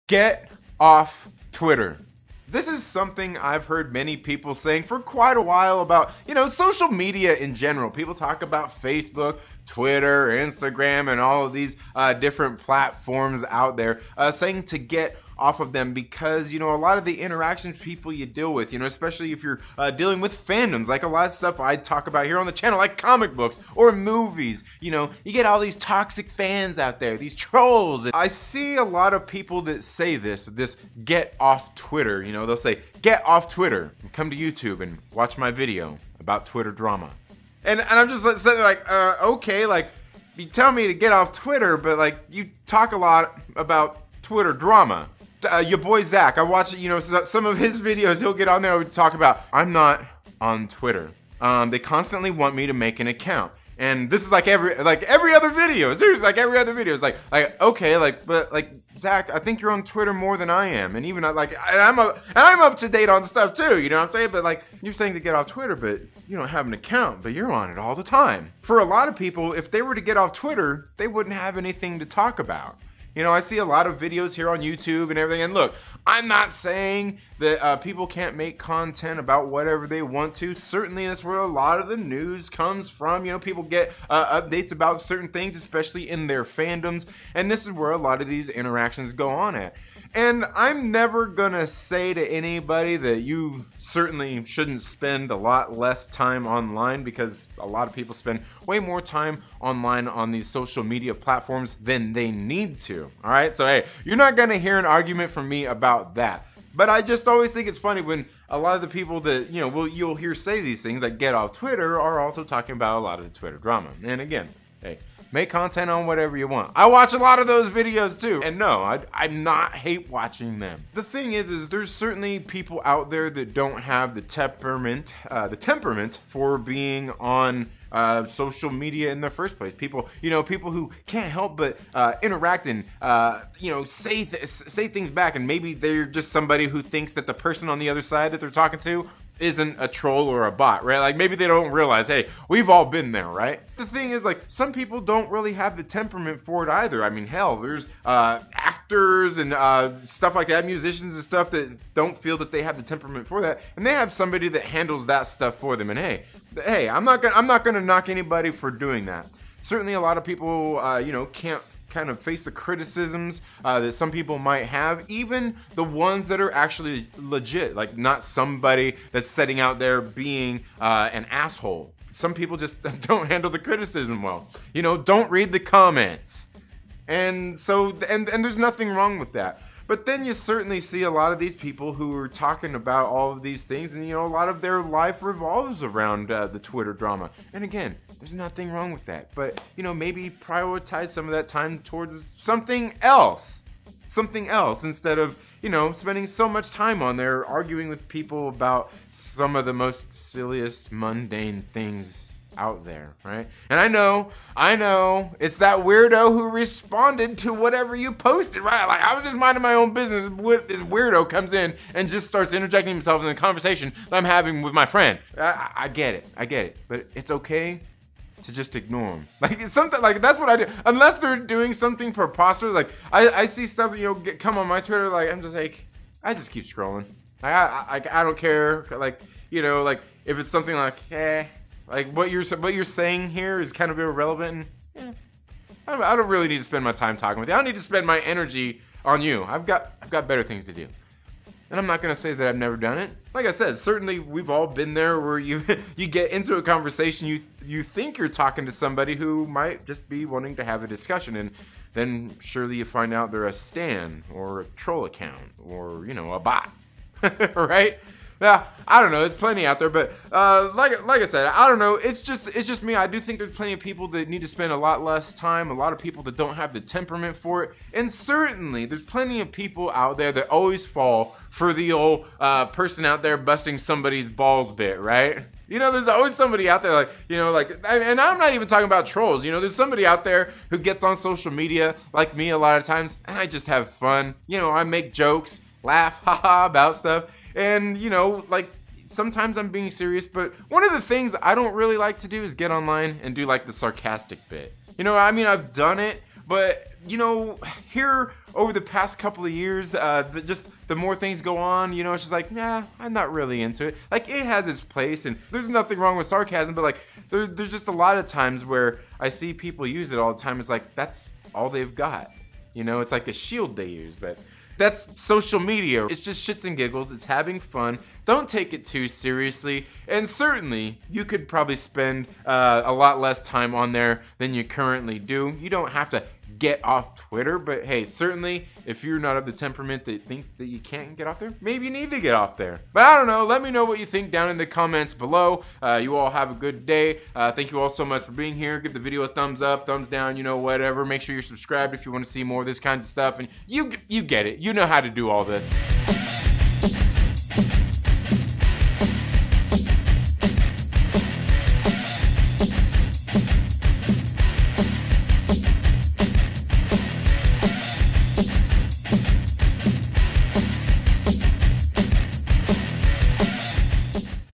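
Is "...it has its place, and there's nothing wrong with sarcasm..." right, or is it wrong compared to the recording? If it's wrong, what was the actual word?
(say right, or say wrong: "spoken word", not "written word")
right.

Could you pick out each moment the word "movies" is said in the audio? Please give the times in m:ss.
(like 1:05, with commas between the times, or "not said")
0:23.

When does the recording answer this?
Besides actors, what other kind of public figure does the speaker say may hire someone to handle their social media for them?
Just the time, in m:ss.
2:30.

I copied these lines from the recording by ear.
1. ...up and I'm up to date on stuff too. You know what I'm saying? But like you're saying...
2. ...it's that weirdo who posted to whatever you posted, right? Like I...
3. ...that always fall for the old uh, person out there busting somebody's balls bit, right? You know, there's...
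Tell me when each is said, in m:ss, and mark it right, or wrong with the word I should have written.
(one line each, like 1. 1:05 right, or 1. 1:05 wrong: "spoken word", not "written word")
1. 1:01 right
2. 3:25 wrong: "responded", not "posted"
3. 4:30 right.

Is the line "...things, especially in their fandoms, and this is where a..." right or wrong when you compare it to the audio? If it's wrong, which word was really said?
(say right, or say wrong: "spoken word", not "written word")
right.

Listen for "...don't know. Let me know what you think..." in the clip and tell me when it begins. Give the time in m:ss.
5:33.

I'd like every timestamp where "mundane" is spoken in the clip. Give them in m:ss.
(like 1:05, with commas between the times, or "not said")
3:20.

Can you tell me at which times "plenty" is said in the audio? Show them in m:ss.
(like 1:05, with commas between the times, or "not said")
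4:19, 4:23, 4:29.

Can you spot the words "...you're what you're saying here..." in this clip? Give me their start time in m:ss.
3:52.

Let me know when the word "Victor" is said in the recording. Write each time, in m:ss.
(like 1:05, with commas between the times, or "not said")
not said.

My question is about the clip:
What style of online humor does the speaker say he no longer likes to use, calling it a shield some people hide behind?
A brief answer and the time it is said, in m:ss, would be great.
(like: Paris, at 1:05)
Sarcasm, at 4:53.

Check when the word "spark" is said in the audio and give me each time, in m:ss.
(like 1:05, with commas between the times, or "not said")
not said.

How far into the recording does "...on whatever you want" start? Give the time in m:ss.
1:55.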